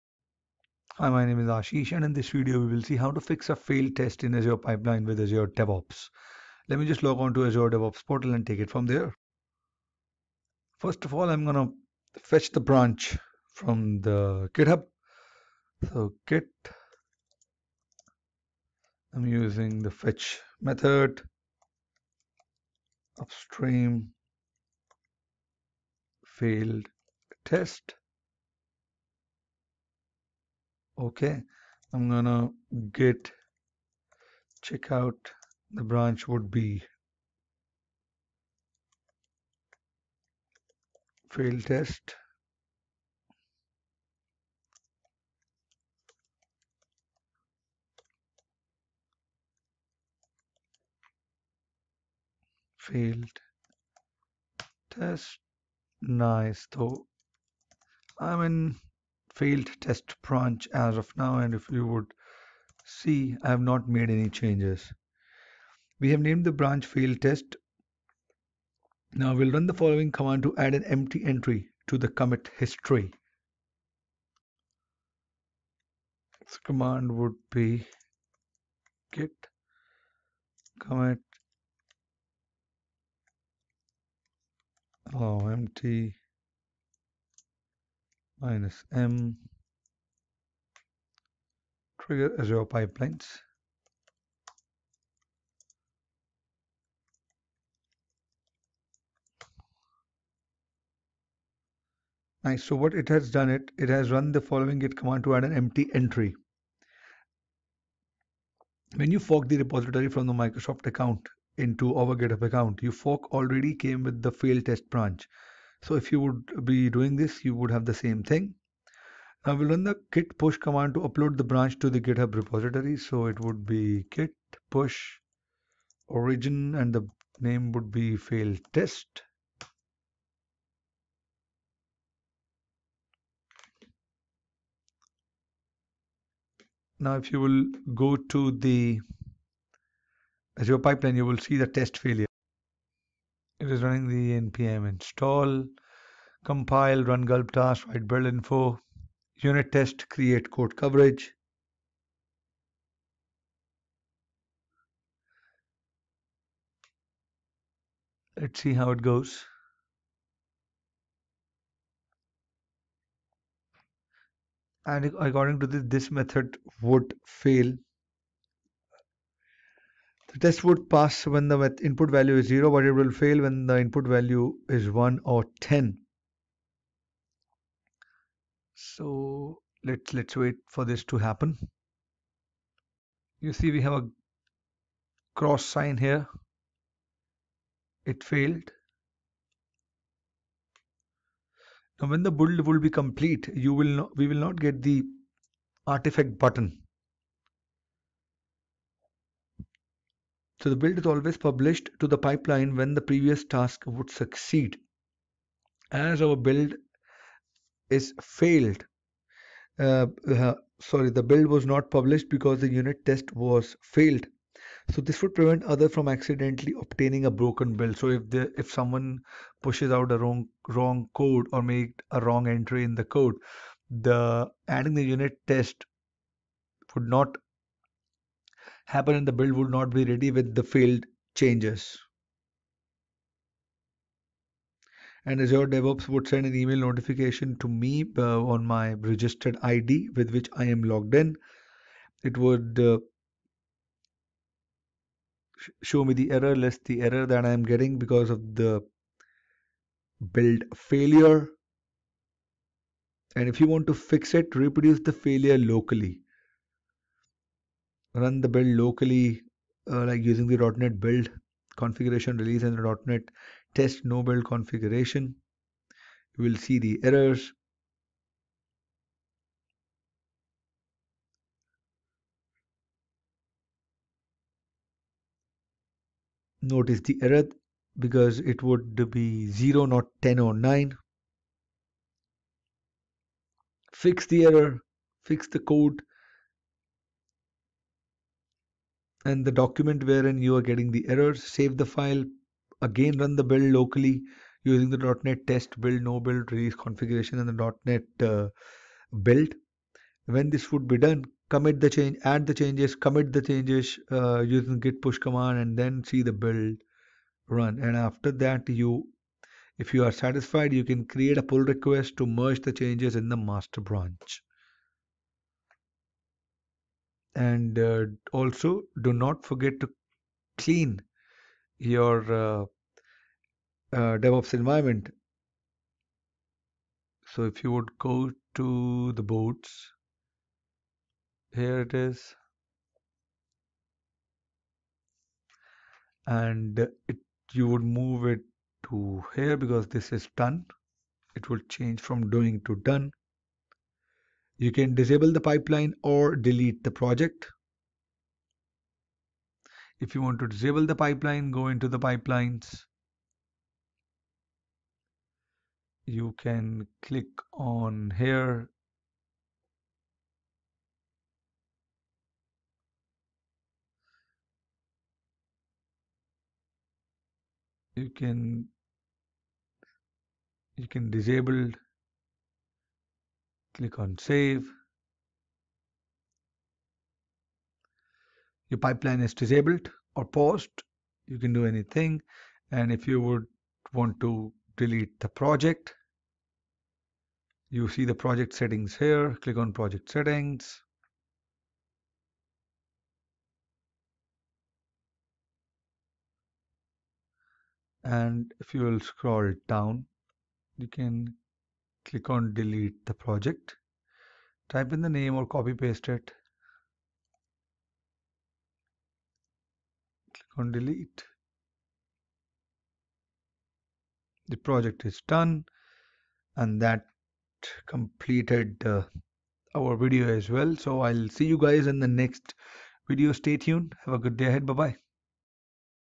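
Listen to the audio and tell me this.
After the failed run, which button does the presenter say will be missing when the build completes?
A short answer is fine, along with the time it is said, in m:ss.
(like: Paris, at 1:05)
artifact button, at 3:15.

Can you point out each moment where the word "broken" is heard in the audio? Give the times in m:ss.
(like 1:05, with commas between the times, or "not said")
3:37.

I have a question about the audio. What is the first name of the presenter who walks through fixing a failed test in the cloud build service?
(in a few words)
Ashish.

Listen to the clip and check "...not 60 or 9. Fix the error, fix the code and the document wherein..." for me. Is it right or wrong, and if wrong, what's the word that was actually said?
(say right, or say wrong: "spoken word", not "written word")
wrong: "10", not "60".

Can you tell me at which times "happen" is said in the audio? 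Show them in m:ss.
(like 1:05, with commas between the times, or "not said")
3:01, 3:48.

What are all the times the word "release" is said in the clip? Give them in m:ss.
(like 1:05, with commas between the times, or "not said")
4:22, 4:56.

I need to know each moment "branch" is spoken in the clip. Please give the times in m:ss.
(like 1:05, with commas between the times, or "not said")
0:12, 0:35, 1:00, 1:06, 1:54, 2:01, 5:13.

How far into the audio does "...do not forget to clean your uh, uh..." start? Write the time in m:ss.
5:19.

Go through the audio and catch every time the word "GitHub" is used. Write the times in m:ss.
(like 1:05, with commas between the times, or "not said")
0:14, 1:52, 2:01.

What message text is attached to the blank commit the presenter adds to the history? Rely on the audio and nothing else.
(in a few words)
trigger Azure pipelines.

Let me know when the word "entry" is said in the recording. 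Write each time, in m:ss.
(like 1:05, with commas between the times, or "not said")
1:11, 1:45, 3:42.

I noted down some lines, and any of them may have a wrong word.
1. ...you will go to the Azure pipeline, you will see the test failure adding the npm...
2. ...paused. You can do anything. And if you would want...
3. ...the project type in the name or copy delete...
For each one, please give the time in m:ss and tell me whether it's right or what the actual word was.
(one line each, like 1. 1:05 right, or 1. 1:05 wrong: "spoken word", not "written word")
1. 2:17 wrong: "running", not "adding"
2. 6:20 right
3. 6:43 wrong: "paste", not "delete".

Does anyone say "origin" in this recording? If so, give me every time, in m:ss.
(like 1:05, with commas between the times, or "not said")
2:06.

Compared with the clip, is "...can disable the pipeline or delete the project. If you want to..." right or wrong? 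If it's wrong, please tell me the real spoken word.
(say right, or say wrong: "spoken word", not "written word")
right.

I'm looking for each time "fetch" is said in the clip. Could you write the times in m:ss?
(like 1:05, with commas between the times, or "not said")
0:12, 0:19.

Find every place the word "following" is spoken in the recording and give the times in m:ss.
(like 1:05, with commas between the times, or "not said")
1:09, 1:44.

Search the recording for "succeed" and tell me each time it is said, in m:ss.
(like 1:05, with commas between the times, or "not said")
3:24.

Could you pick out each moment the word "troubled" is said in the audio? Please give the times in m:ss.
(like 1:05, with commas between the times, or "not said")
not said.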